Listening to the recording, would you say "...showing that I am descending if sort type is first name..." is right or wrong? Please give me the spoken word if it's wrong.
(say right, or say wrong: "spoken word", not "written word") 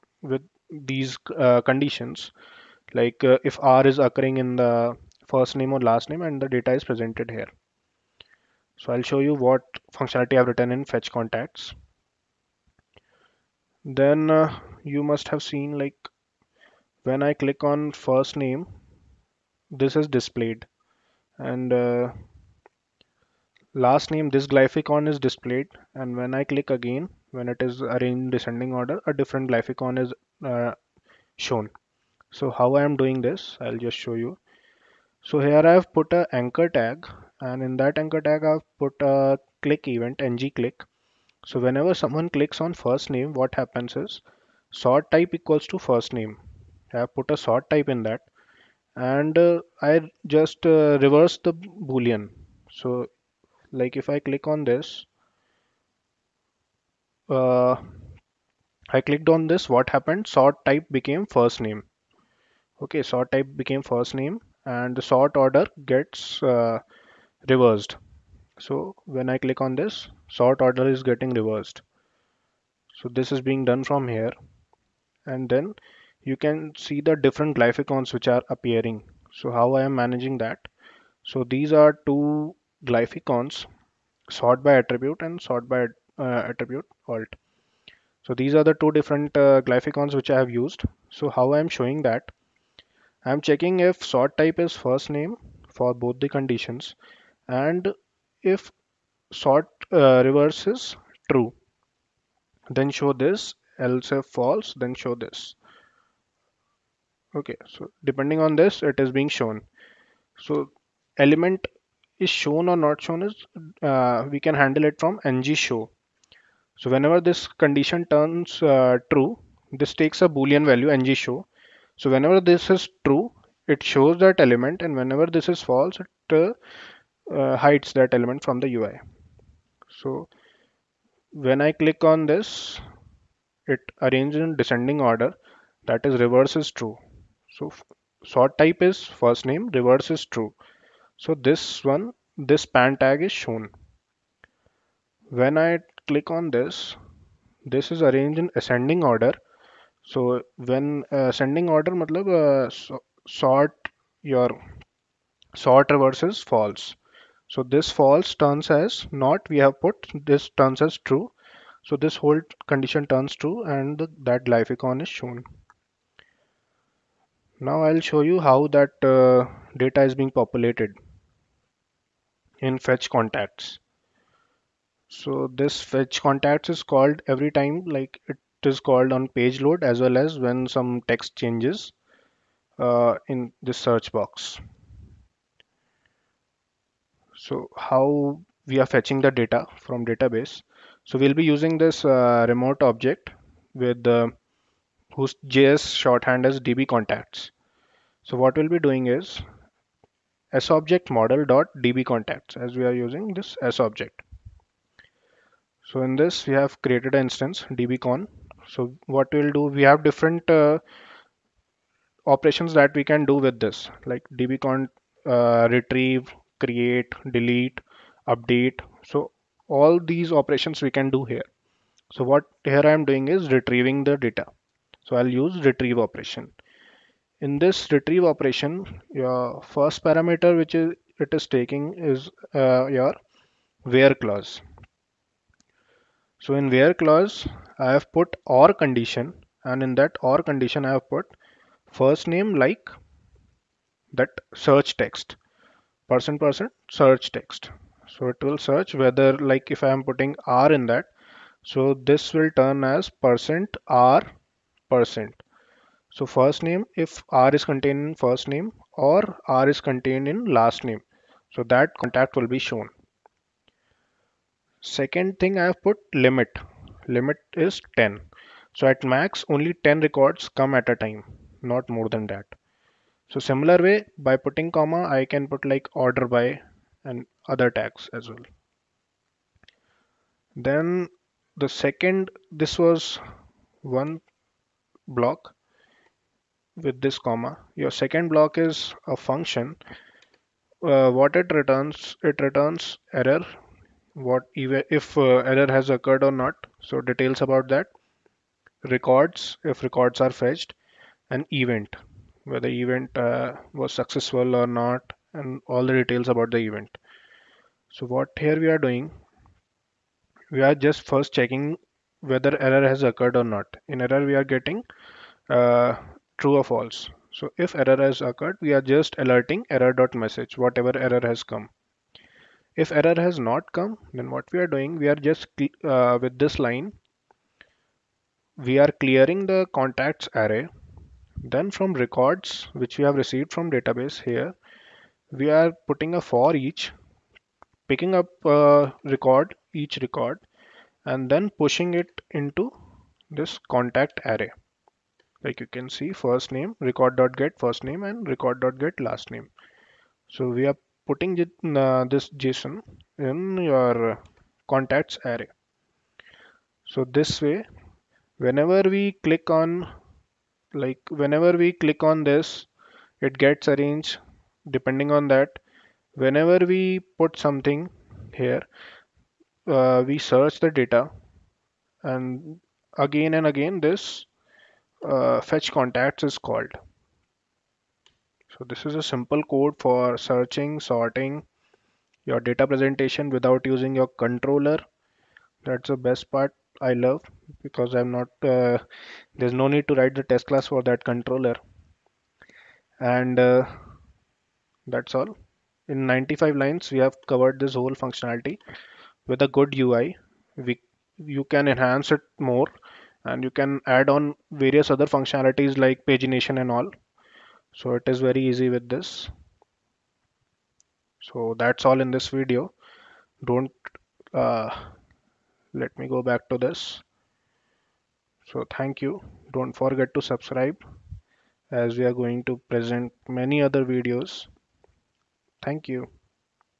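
wrong: "checking", not "descending".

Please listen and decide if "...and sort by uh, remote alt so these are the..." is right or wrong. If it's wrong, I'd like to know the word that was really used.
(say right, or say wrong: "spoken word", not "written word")
wrong: "attribute", not "remote".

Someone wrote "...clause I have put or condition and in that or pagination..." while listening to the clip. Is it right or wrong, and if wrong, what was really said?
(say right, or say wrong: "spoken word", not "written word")
wrong: "condition", not "pagination".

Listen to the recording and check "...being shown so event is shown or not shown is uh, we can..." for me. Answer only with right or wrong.
wrong.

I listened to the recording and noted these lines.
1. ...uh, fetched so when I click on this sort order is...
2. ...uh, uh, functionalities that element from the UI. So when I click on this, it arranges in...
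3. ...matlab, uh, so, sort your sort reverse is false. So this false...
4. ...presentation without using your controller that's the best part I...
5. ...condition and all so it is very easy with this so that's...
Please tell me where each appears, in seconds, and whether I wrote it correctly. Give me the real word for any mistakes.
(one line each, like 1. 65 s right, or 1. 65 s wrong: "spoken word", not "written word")
1. 66 s wrong: "reversed", not "fetched"
2. 126 s wrong: "hides", not "functionalities"
3. 151 s right
4. 382 s right
5. 406 s wrong: "pagination", not "condition".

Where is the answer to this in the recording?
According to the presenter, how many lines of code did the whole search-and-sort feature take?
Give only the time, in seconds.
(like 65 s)
396 s.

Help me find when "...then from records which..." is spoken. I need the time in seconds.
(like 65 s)
331 s.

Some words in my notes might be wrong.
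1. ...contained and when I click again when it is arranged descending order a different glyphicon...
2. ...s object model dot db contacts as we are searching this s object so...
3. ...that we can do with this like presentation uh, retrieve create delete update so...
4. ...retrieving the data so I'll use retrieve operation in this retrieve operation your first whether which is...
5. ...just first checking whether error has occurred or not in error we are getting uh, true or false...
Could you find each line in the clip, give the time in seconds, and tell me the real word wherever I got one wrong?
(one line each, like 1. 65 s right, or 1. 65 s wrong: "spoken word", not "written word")
1. 25 s wrong: "displayed", not "contained"
2. 200 s wrong: "using", not "searching"
3. 212 s wrong: "dbcon", not "presentation"
4. 223 s wrong: "parameter", not "whether"
5. 310 s right.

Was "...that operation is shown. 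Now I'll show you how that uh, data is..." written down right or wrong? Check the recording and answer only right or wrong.
wrong.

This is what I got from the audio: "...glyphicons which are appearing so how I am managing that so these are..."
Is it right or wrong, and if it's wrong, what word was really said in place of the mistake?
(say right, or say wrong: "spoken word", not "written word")
right.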